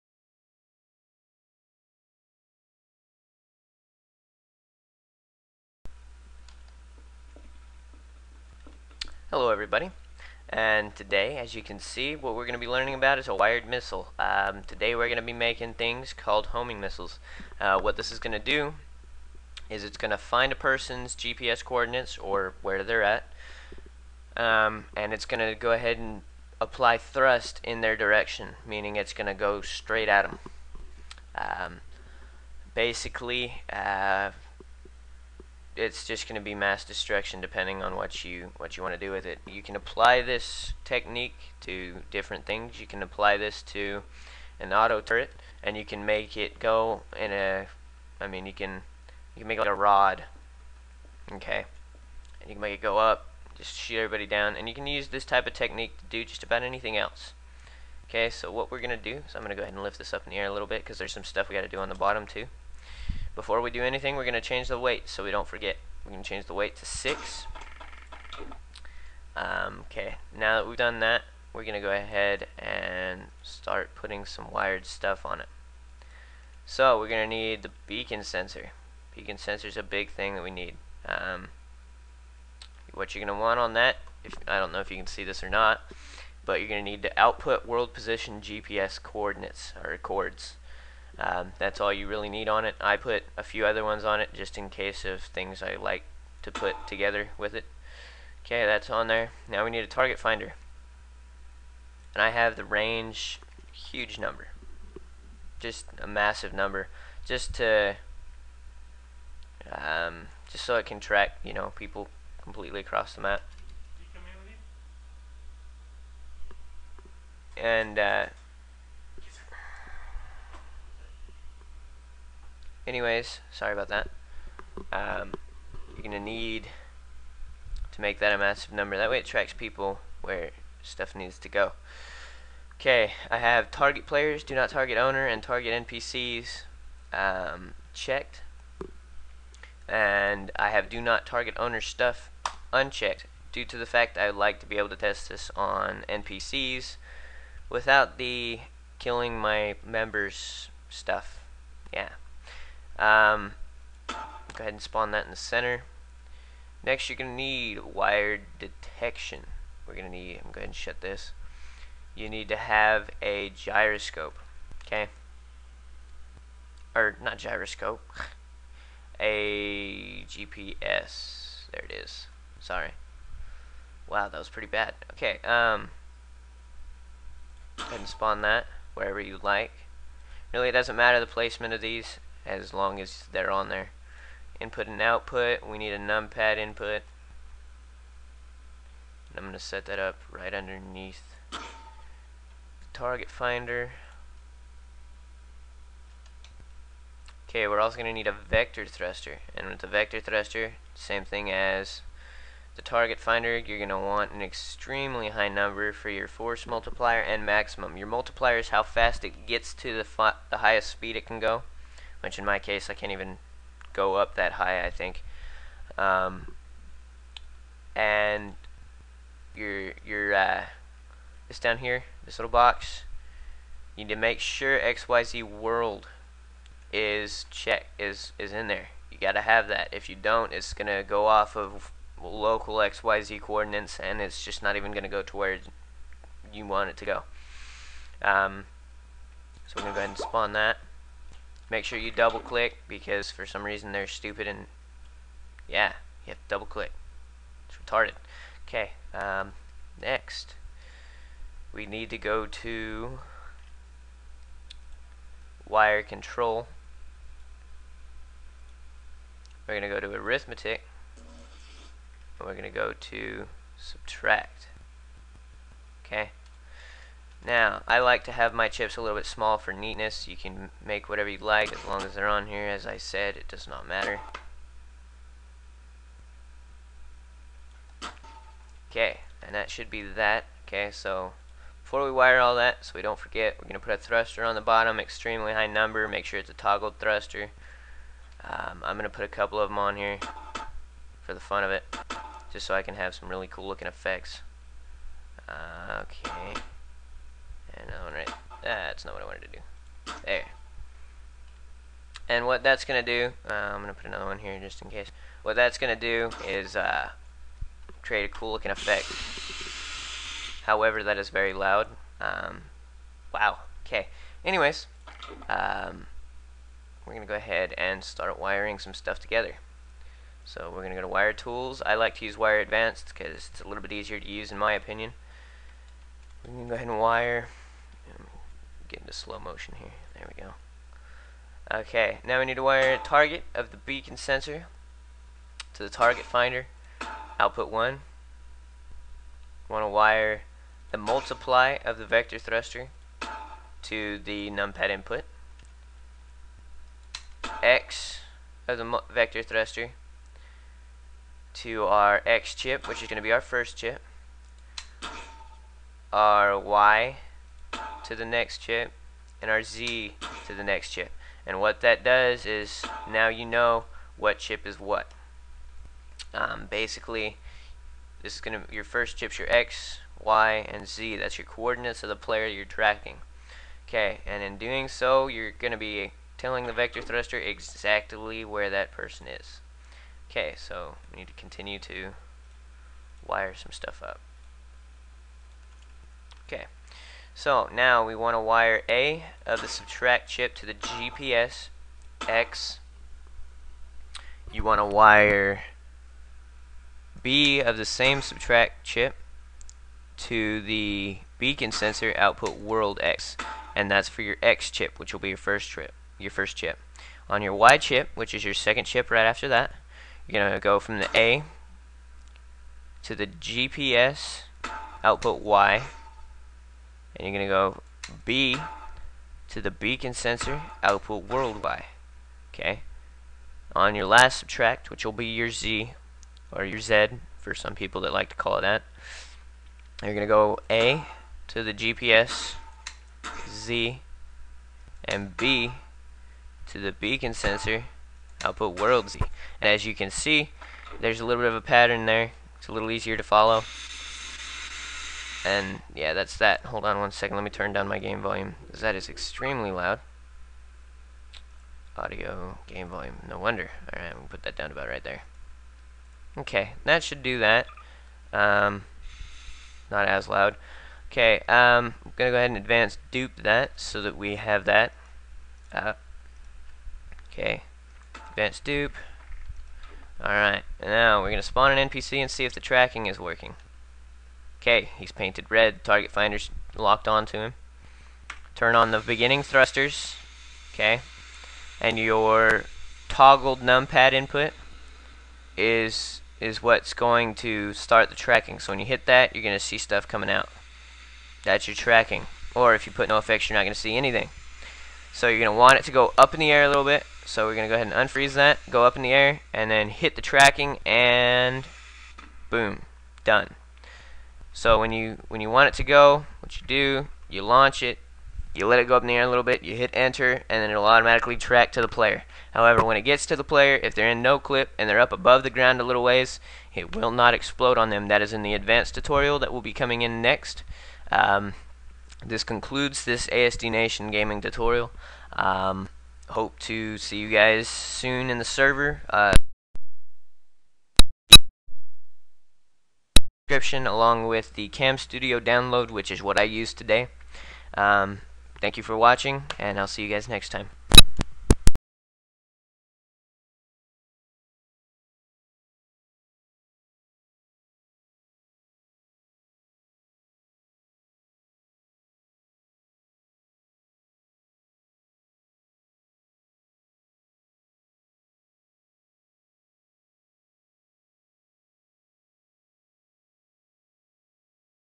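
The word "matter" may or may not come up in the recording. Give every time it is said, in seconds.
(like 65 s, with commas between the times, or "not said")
180 s, 273 s.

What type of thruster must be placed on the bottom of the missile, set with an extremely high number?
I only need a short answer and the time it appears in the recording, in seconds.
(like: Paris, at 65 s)
Toggled thruster, at 286 s.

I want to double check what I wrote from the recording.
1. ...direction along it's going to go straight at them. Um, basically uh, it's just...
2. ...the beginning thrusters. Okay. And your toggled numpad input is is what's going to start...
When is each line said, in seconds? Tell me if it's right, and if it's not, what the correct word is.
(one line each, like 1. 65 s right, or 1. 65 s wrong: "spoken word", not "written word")
1. 27 s wrong: "meaning", not "along"
2. 478 s right.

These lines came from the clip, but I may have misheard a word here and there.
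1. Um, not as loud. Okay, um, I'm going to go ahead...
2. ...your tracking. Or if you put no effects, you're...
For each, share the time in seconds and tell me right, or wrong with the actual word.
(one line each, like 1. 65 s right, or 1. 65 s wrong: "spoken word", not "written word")
1. 458 s right
2. 491 s right.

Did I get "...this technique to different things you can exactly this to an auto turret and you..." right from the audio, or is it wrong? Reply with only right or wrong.
wrong.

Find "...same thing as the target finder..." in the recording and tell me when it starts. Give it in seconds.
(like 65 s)
200 s.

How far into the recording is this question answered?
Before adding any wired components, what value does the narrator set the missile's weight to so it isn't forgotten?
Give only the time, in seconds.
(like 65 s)
66 s.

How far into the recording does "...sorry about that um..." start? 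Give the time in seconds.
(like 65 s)
123 s.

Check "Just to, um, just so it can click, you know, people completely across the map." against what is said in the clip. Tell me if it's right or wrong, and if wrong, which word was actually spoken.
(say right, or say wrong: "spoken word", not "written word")
wrong: "track", not "click".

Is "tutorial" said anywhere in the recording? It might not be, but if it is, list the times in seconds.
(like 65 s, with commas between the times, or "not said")
518 s, 524 s.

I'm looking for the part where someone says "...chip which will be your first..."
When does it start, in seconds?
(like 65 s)
404 s.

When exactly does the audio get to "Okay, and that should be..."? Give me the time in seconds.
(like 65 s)
278 s.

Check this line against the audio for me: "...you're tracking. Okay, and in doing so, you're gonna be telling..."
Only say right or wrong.
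right.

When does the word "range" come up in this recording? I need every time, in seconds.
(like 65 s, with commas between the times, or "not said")
102 s.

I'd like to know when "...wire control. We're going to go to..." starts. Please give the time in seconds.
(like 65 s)
255 s.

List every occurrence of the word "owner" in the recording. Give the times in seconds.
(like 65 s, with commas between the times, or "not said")
134 s, 141 s.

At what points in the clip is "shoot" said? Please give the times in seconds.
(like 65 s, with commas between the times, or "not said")
53 s.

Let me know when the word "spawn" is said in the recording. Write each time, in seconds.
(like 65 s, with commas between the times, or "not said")
154 s, 178 s, 240 s, 471 s.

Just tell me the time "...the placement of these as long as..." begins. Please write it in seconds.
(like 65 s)
181 s.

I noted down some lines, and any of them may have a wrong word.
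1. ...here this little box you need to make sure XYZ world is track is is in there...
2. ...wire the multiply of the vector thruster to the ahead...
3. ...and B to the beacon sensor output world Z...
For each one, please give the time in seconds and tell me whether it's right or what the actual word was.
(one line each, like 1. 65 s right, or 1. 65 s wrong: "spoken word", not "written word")
1. 221 s wrong: "check", not "track"
2. 339 s wrong: "numpad", not "ahead"
3. 435 s right.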